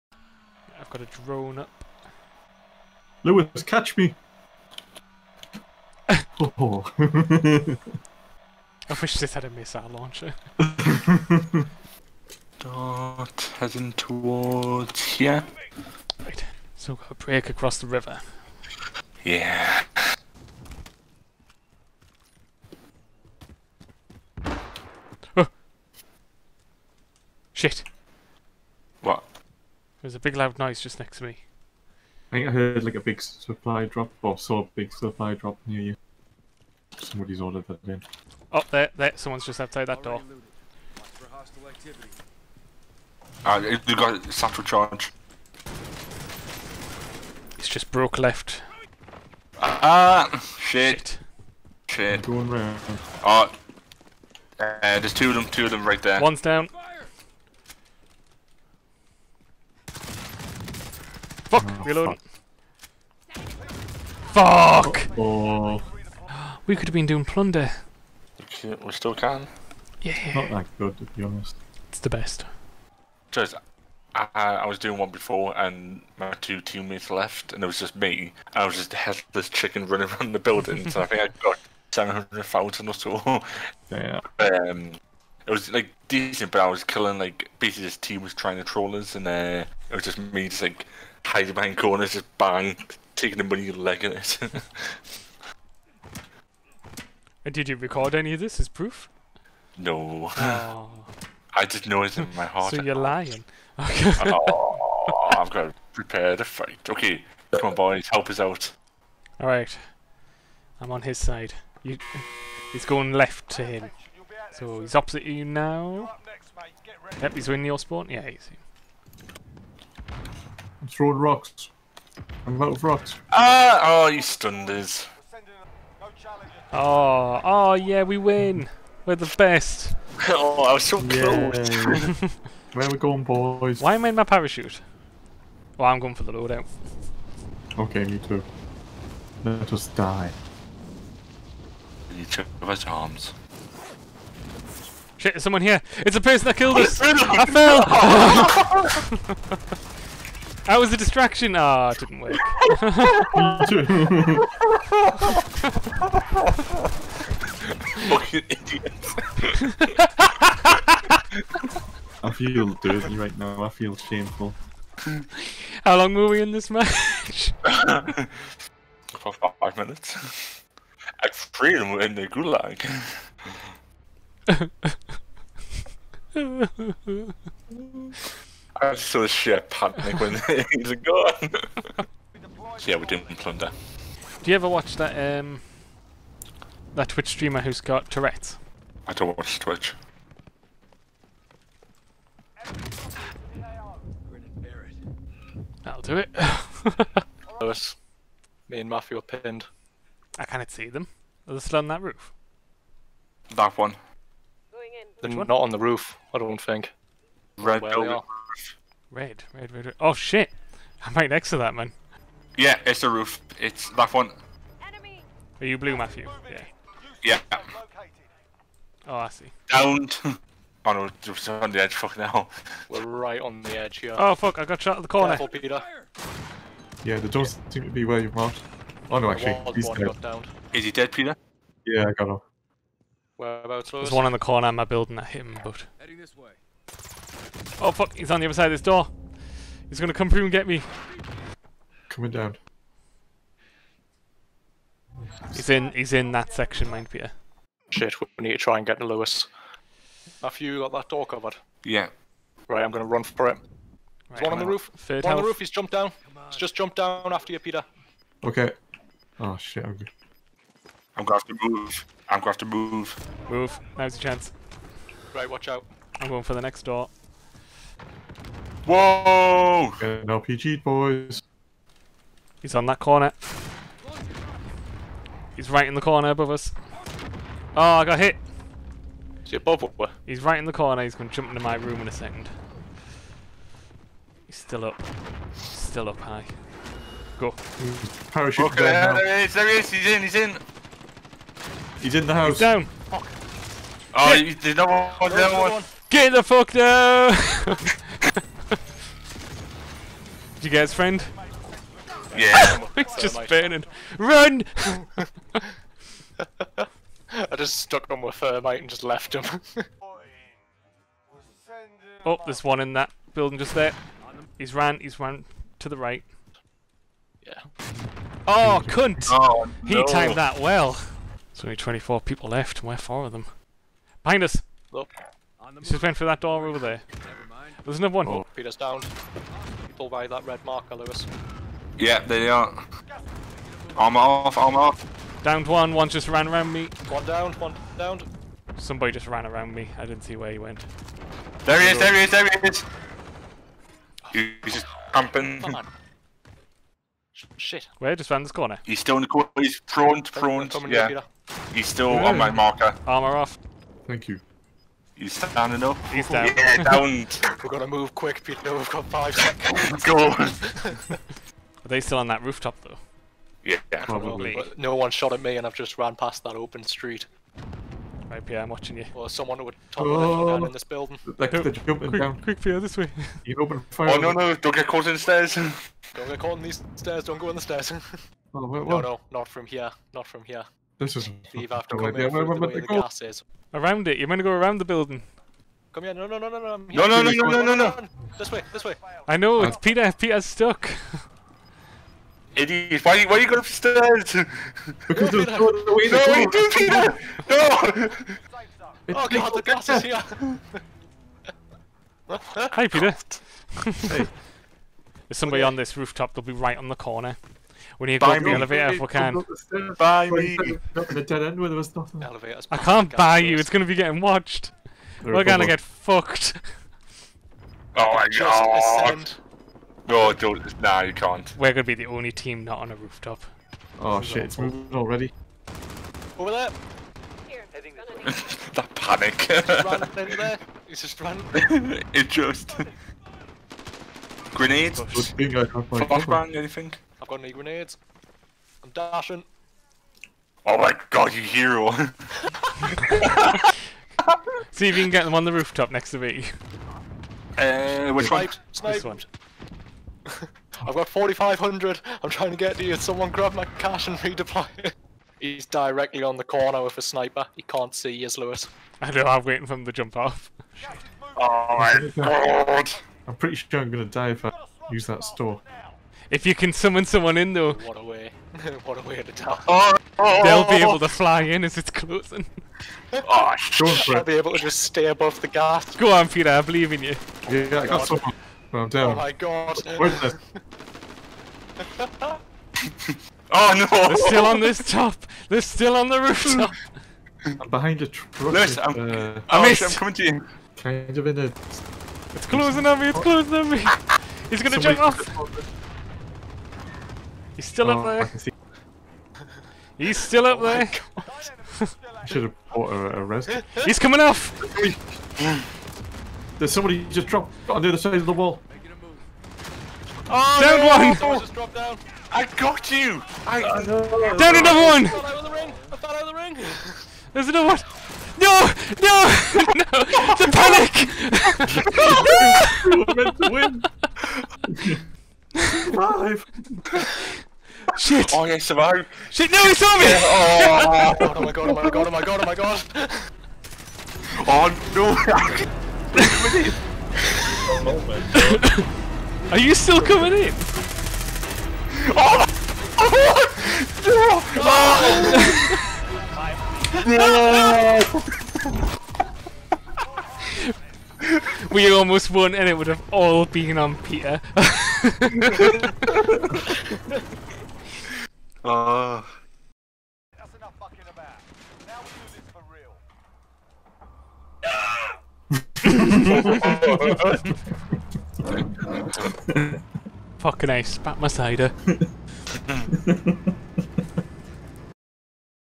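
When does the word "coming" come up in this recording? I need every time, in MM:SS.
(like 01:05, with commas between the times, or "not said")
04:02, 08:09, 08:23, 09:00.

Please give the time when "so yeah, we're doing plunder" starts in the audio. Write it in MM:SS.
03:02.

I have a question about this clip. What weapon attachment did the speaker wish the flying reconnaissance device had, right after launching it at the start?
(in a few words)
missile launcher.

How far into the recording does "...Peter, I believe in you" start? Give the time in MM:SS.
07:56.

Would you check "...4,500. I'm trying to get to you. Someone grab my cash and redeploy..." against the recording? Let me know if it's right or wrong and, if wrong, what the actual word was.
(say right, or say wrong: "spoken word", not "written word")
right.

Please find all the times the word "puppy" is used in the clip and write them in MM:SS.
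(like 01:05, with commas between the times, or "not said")
not said.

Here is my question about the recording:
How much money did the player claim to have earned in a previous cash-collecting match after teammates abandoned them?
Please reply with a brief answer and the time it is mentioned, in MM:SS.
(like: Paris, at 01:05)
700,000, at 01:21.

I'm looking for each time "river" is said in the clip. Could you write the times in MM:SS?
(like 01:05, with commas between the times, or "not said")
00:17.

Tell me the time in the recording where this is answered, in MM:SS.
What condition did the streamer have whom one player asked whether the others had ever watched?
03:08.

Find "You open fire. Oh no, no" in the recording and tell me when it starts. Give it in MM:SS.
06:13.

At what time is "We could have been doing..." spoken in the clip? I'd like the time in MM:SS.
01:06.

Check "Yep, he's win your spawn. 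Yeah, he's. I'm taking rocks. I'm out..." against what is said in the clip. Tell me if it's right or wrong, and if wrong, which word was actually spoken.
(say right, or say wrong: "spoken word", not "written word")
wrong: "throwing", not "taking".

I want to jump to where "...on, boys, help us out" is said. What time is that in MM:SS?
01:47.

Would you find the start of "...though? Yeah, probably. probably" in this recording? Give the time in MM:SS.
06:02.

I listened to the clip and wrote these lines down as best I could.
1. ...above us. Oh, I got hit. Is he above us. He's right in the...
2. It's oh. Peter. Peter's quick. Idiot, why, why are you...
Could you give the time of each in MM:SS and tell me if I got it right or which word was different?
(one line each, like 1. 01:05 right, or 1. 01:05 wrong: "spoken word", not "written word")
1. 04:36 right
2. 06:29 wrong: "stuck", not "quick".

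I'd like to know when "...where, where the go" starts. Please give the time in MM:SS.
06:22.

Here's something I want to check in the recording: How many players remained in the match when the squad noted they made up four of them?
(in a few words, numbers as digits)
24.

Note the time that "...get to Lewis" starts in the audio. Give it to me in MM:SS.
04:08.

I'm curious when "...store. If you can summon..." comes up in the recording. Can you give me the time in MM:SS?
07:45.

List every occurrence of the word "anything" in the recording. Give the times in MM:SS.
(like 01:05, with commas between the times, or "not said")
07:16.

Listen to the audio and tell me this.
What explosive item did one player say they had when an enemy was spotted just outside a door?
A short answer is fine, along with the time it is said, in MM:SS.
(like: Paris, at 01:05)
satchel charge, at 00:44.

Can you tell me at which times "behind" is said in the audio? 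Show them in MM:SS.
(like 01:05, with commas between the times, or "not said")
01:31, 05:24, 08:07.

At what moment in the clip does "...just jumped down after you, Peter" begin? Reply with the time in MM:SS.
04:16.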